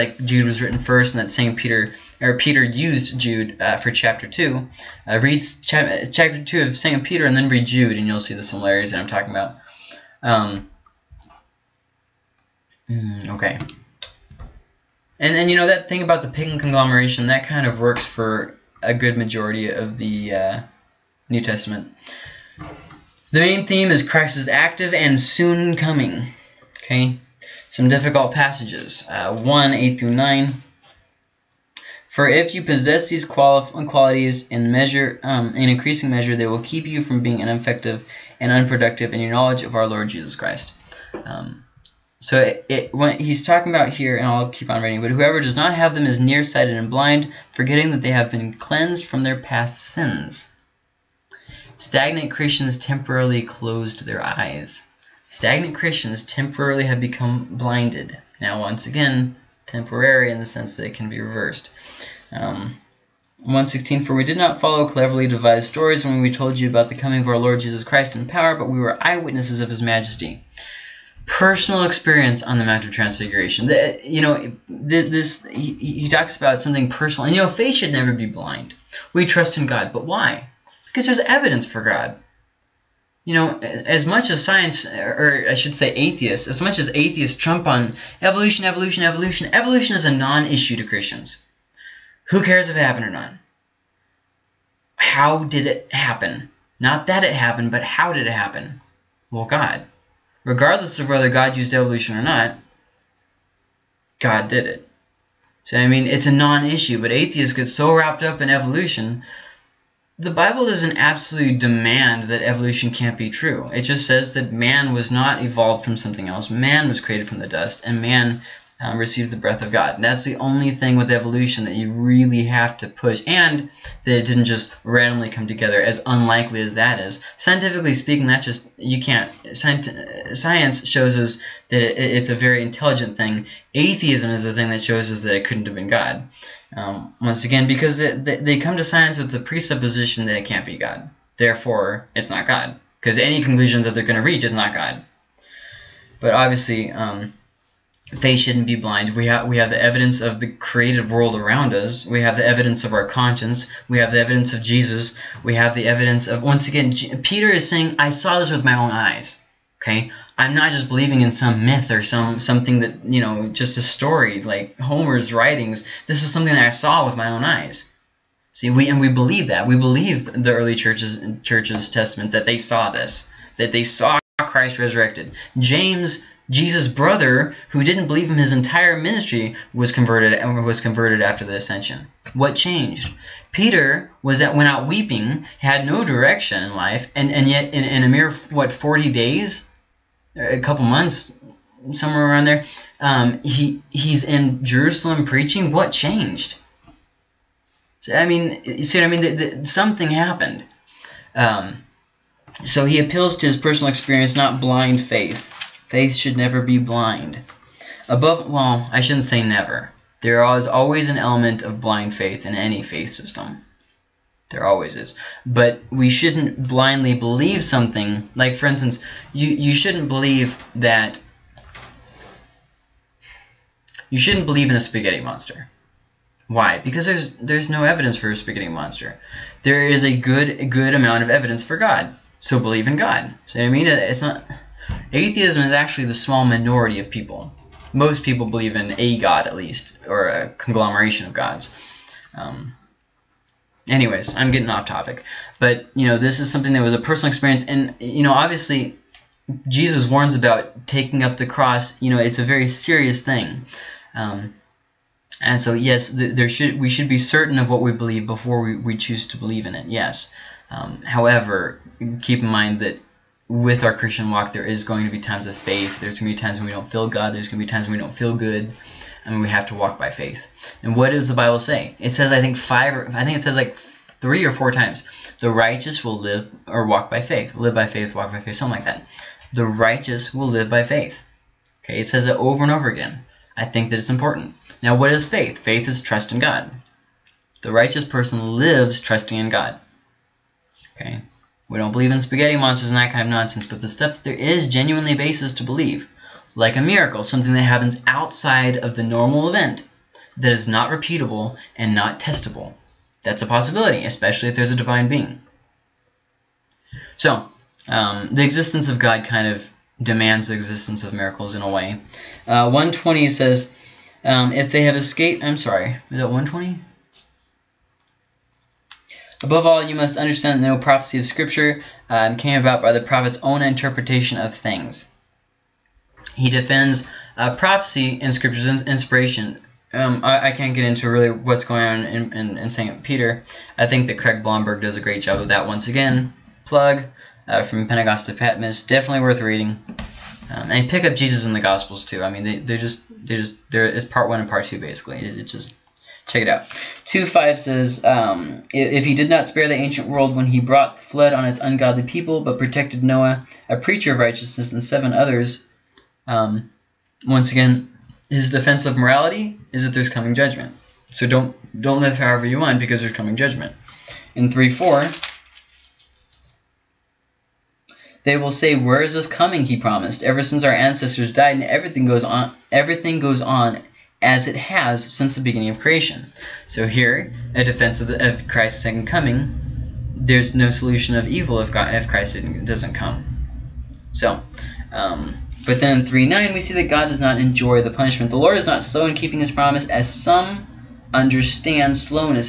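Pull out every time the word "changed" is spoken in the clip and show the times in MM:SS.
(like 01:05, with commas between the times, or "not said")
03:02, 03:15.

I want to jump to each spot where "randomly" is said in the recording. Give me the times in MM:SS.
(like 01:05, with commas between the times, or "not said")
02:04.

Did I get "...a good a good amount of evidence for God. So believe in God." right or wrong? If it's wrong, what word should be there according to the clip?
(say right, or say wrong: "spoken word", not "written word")
right.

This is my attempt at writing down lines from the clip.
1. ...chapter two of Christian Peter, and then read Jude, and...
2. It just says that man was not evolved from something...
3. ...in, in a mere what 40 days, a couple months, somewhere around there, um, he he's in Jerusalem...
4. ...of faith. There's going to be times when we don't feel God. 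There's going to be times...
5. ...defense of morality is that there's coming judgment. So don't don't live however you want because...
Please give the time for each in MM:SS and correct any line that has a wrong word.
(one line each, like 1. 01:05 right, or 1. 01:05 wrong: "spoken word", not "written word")
1. 00:06 wrong: "Second", not "Christian"
2. 01:53 right
3. 03:07 right
4. 04:25 right
5. 05:58 right.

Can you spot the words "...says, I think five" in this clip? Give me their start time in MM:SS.
04:32.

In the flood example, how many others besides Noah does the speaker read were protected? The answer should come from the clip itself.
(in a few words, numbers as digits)
7.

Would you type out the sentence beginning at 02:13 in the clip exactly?
Atheism is the thing that shows us that it couldn't have been God.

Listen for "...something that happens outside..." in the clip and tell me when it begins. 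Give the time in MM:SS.
04:57.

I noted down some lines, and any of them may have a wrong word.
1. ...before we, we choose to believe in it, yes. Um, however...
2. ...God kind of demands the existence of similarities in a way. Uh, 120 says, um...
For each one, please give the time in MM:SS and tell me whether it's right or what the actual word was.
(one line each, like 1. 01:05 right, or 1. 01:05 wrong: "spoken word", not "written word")
1. 04:18 right
2. 05:08 wrong: "miracles", not "similarities".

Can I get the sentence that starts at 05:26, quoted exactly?
He defends uh, prophecy in Scripture's inspiration.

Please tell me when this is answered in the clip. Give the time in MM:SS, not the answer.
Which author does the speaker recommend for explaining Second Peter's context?
05:34.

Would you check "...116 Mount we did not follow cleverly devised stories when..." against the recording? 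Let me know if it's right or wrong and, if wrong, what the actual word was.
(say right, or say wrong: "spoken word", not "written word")
wrong: "For", not "Mount".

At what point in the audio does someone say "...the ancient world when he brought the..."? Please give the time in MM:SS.
05:49.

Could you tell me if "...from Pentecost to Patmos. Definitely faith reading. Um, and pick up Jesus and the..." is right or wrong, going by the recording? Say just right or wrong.
wrong.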